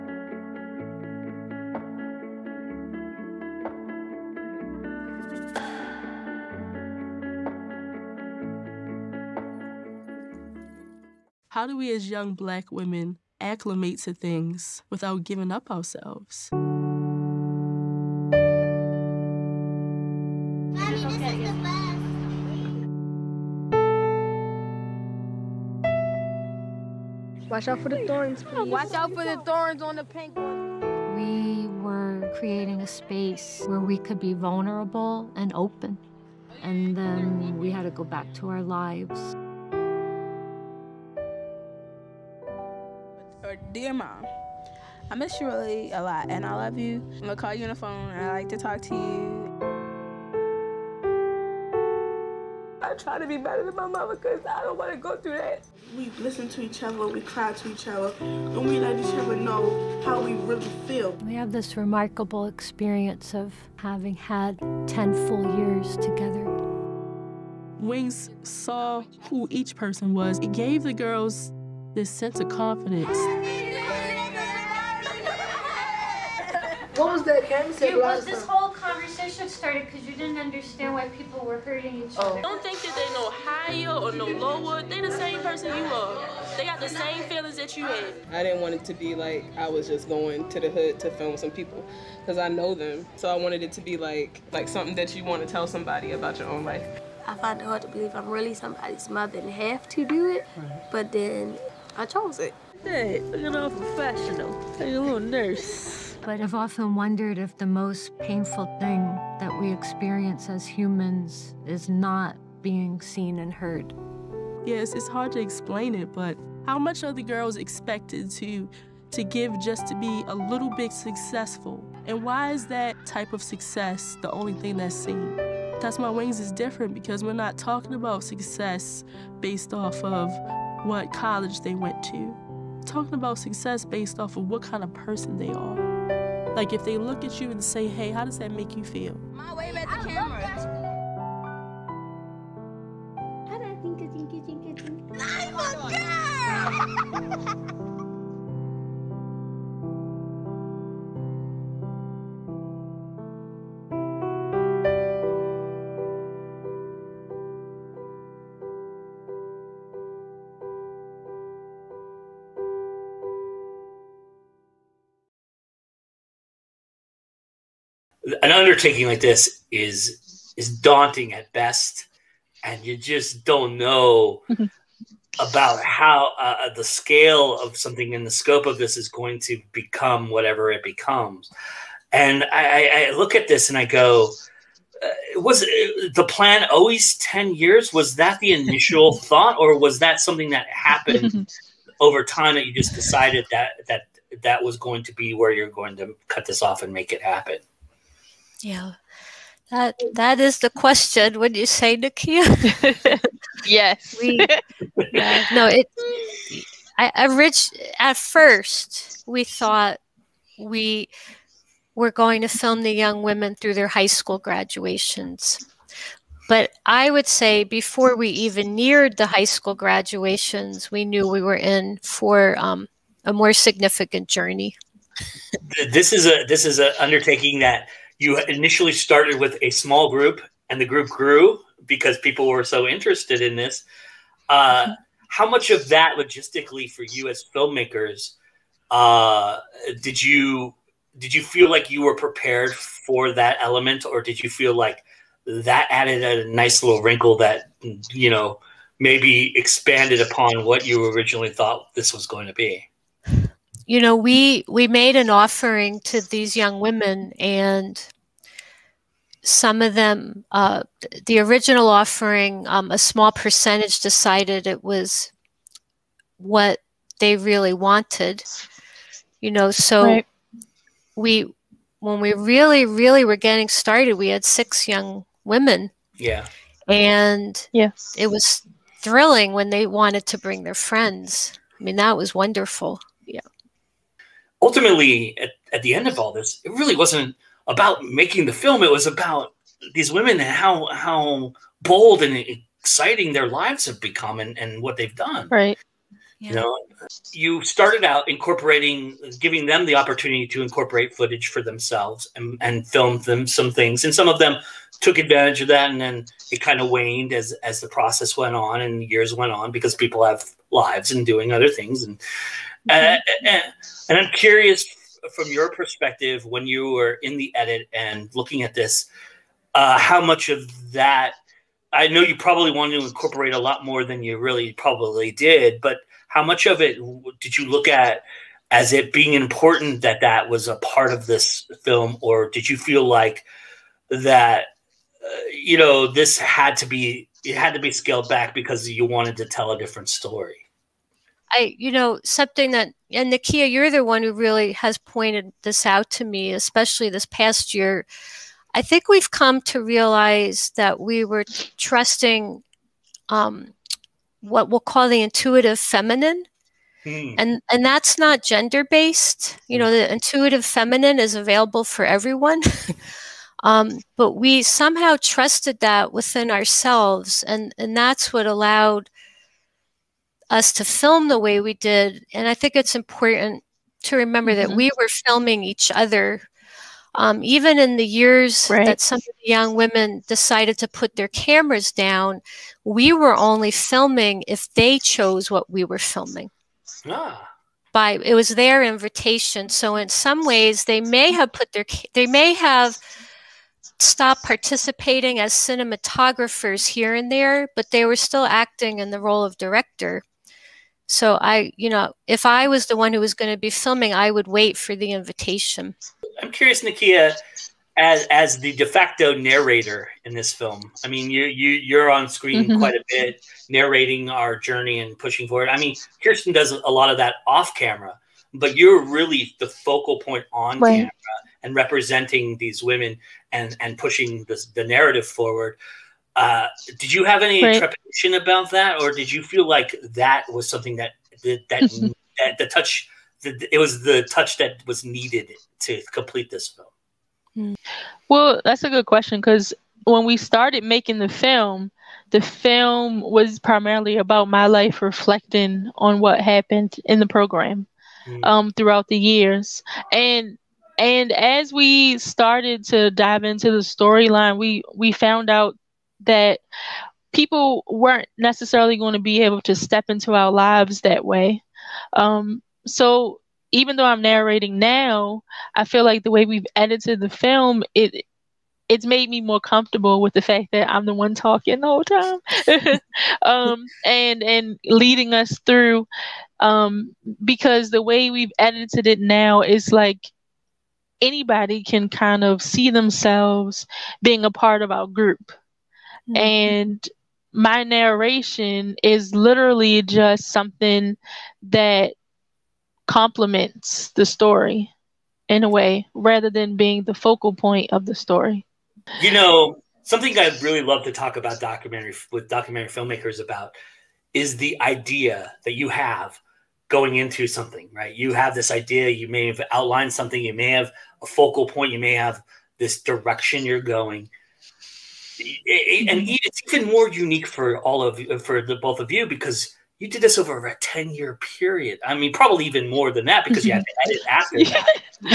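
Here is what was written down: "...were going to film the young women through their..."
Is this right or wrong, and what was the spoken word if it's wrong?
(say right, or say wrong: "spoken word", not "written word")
right.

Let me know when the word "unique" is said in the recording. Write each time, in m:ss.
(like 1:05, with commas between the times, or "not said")
8:37.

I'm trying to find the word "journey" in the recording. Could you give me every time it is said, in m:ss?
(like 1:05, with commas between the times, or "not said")
3:44, 6:54.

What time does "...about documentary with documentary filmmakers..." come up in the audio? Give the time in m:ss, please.
8:21.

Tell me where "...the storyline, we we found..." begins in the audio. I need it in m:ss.
7:33.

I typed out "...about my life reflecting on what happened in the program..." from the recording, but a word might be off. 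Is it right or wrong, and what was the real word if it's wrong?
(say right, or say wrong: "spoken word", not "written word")
right.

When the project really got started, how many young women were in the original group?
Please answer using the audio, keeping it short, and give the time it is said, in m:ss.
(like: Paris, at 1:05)
6, at 4:34.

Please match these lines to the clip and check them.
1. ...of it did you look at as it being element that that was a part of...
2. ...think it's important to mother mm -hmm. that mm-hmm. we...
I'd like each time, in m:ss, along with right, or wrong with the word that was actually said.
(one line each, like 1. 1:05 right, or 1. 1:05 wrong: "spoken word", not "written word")
1. 5:26 wrong: "important", not "element"
2. 6:12 wrong: "remember", not "mother".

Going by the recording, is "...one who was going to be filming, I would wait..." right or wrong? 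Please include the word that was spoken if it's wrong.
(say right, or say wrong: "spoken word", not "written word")
right.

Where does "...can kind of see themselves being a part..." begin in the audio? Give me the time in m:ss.
8:01.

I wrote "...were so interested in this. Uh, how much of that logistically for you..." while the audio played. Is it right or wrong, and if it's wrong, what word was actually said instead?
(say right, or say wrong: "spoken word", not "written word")
right.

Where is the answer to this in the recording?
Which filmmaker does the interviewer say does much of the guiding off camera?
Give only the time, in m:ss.
6:56.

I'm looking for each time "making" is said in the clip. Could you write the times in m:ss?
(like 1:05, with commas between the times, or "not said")
4:48, 7:20.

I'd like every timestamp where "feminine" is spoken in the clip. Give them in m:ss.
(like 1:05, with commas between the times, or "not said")
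5:55, 6:00.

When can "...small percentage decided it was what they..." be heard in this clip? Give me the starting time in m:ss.
4:22.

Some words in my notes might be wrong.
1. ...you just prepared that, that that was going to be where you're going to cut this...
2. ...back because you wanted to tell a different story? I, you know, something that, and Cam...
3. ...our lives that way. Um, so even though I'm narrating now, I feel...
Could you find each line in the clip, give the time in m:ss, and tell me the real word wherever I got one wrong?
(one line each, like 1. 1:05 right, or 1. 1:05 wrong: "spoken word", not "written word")
1. 3:12 wrong: "decided", not "prepared"
2. 5:38 wrong: "Nikiea", not "Cam"
3. 7:40 right.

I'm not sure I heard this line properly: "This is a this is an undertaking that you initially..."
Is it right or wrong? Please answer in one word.
right.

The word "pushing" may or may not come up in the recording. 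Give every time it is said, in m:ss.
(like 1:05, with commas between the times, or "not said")
6:55, 7:03.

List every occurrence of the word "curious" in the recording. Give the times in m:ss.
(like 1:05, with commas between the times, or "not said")
5:14, 6:46.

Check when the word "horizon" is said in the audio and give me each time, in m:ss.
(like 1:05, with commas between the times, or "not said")
not said.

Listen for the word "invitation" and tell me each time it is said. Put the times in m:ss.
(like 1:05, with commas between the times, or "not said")
6:28, 6:45.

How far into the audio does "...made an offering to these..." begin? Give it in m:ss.
4:14.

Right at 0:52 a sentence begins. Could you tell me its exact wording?
I try to be better than my mama because I don't want to go through that.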